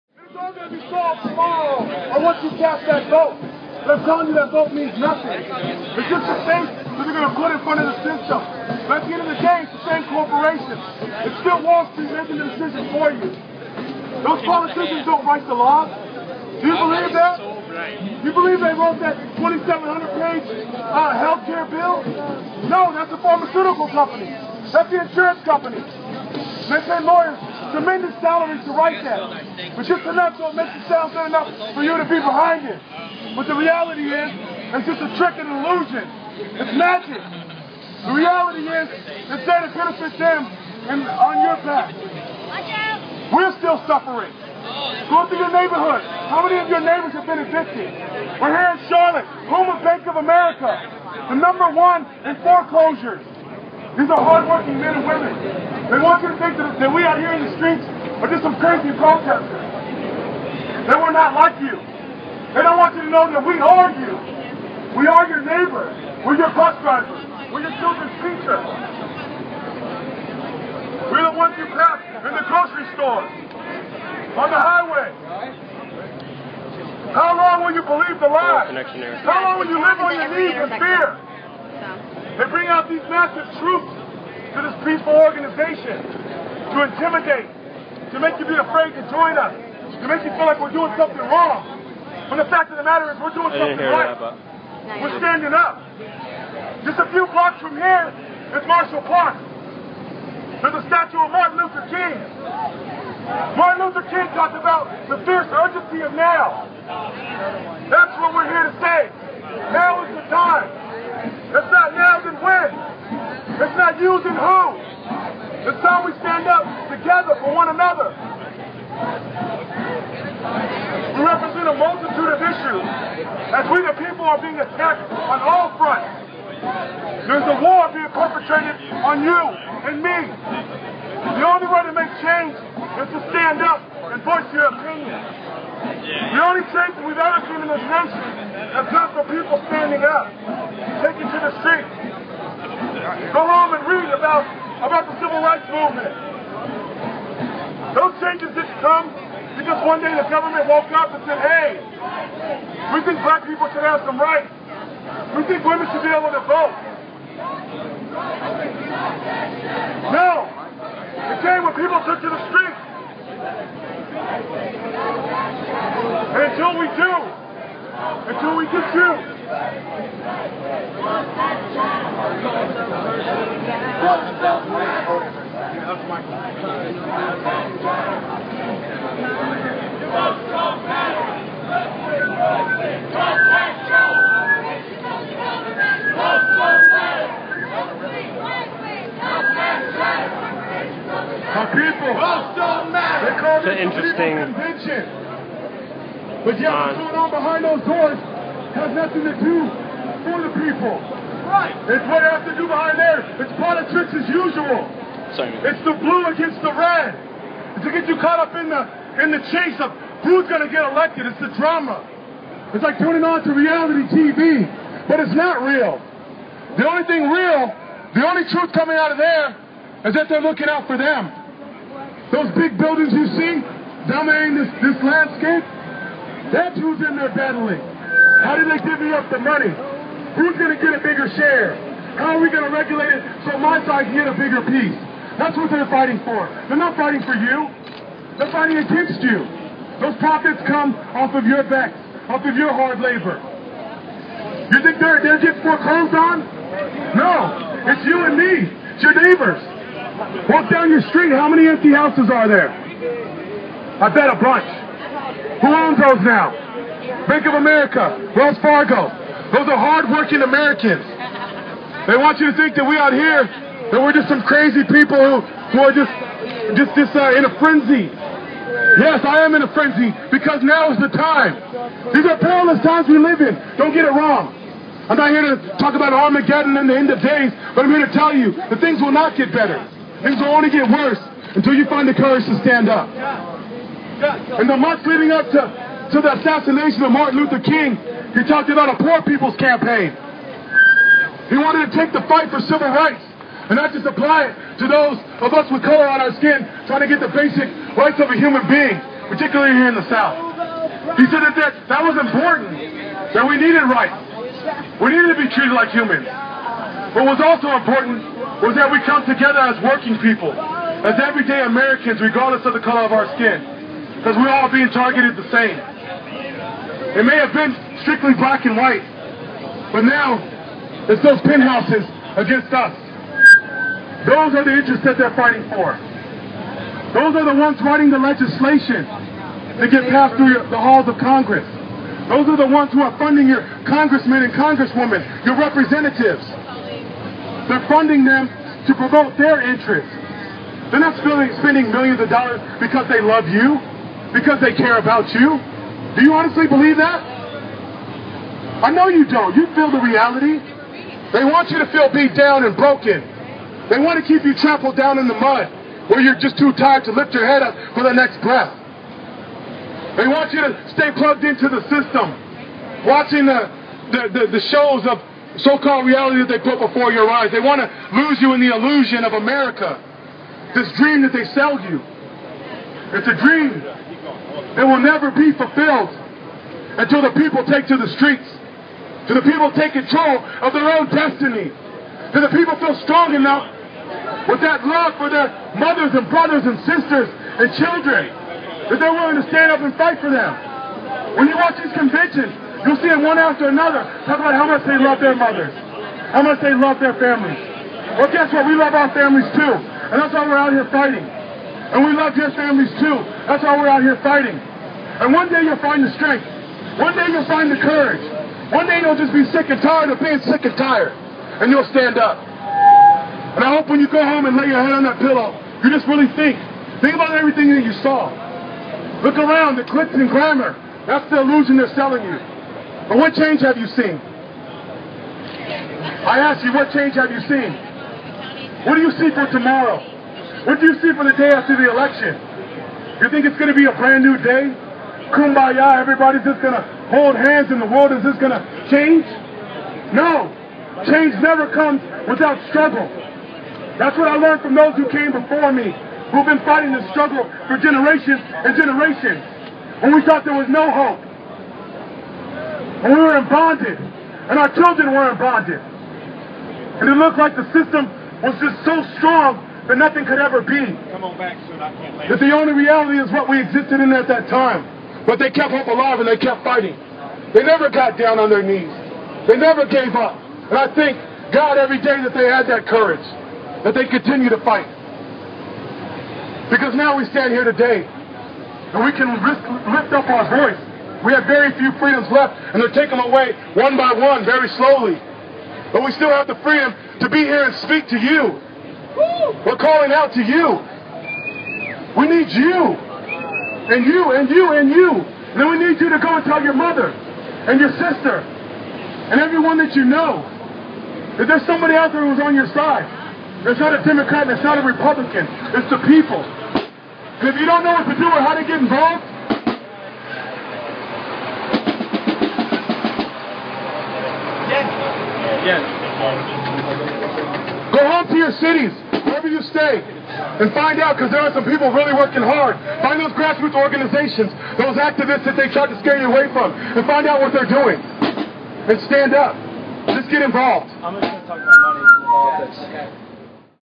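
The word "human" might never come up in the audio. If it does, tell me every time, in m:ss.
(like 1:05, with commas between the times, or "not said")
4:58, 5:05.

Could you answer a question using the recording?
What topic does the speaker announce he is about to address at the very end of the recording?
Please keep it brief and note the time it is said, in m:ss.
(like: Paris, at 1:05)
money in politics, at 8:51.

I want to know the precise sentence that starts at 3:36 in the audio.
The only thing real, the only truth coming out of there, is that they're looking out for them.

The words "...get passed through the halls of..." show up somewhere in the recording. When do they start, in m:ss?
5:29.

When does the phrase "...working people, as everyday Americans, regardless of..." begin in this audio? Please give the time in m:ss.
5:09.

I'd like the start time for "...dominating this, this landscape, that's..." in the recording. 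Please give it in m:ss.
3:44.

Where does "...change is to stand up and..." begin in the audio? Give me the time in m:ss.
2:12.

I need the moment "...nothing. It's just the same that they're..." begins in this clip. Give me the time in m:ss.
0:04.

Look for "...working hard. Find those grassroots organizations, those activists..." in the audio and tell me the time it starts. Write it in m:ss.
8:42.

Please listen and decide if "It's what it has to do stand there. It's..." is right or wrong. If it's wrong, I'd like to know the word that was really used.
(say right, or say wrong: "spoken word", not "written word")
wrong: "behind", not "stand".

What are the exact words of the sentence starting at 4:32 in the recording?
These are perilous times we live in.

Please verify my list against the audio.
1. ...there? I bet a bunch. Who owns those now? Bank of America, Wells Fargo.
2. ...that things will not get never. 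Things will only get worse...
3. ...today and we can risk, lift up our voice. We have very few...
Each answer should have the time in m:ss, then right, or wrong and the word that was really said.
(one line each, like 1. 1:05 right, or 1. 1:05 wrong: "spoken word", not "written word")
1. 4:12 right
2. 4:38 wrong: "better", not "never"
3. 7:57 right.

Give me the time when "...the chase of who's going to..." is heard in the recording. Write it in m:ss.
3:29.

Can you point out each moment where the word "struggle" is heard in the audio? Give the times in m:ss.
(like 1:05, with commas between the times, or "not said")
7:22, 7:27.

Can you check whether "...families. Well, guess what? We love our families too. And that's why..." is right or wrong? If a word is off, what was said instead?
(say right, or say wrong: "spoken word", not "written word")
right.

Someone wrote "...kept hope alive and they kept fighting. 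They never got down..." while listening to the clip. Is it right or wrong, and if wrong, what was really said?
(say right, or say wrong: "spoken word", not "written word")
right.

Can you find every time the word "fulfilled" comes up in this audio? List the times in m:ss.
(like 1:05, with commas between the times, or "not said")
6:15.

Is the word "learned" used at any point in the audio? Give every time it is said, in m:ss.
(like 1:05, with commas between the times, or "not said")
7:24.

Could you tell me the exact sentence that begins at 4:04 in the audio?
You think they're, they're getting foreclosed on?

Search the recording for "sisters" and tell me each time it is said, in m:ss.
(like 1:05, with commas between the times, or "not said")
6:26, 8:17.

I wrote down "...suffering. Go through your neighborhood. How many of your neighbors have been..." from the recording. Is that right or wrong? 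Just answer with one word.
right.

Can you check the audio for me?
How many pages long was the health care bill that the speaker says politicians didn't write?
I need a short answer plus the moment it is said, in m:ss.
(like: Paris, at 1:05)
2,700, at 0:19.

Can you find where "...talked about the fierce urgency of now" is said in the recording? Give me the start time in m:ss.
1:44.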